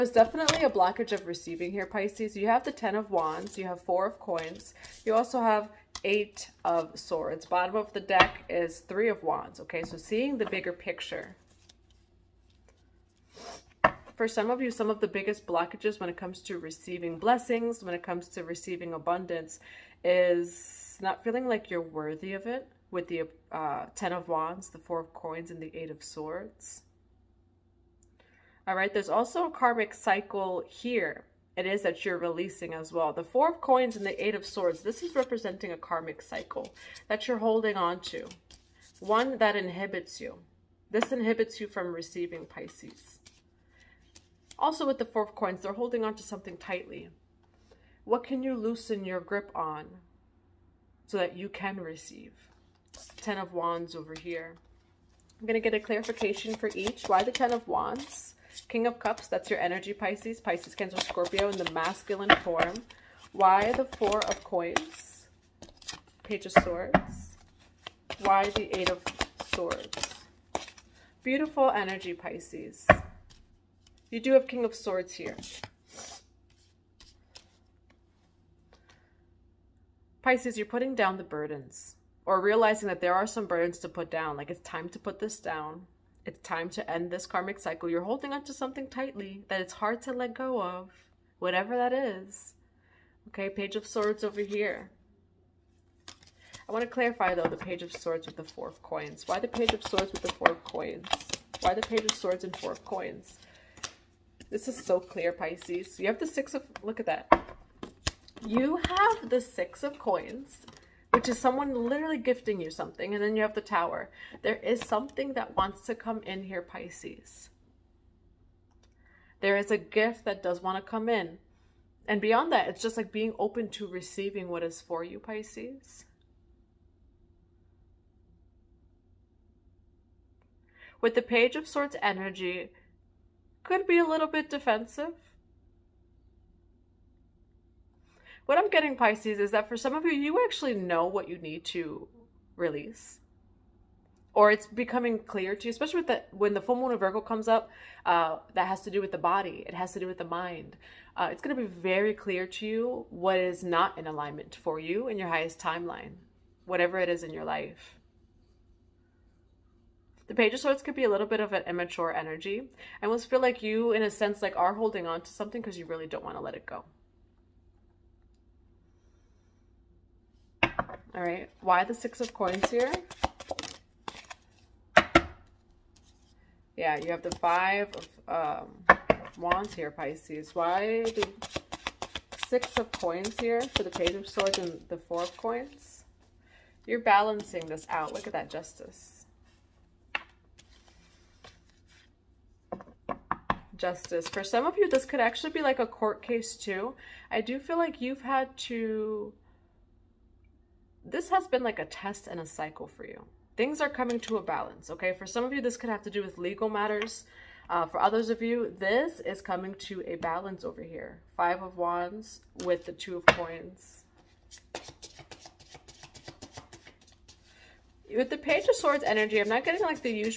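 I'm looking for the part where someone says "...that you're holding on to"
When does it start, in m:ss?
0:37.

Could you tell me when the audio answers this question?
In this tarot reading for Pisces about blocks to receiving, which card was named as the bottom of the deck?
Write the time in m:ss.
0:08.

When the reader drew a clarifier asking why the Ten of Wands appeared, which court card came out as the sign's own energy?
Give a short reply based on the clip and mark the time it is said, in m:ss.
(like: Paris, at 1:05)
King of Cups, at 0:58.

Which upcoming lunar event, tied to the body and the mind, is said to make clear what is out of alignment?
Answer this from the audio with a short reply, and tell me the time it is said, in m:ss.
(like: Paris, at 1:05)
full moon of Virgo, at 2:26.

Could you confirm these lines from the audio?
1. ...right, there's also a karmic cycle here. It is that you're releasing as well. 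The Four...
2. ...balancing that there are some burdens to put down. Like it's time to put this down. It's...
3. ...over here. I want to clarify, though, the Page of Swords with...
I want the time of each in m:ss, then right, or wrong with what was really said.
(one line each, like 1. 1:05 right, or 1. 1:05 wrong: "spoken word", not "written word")
1. 0:28 right
2. 1:22 wrong: "realizing", not "balancing"
3. 1:34 right.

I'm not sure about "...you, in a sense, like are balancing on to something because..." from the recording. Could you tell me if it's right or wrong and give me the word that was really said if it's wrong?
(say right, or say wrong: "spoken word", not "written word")
wrong: "holding", not "balancing".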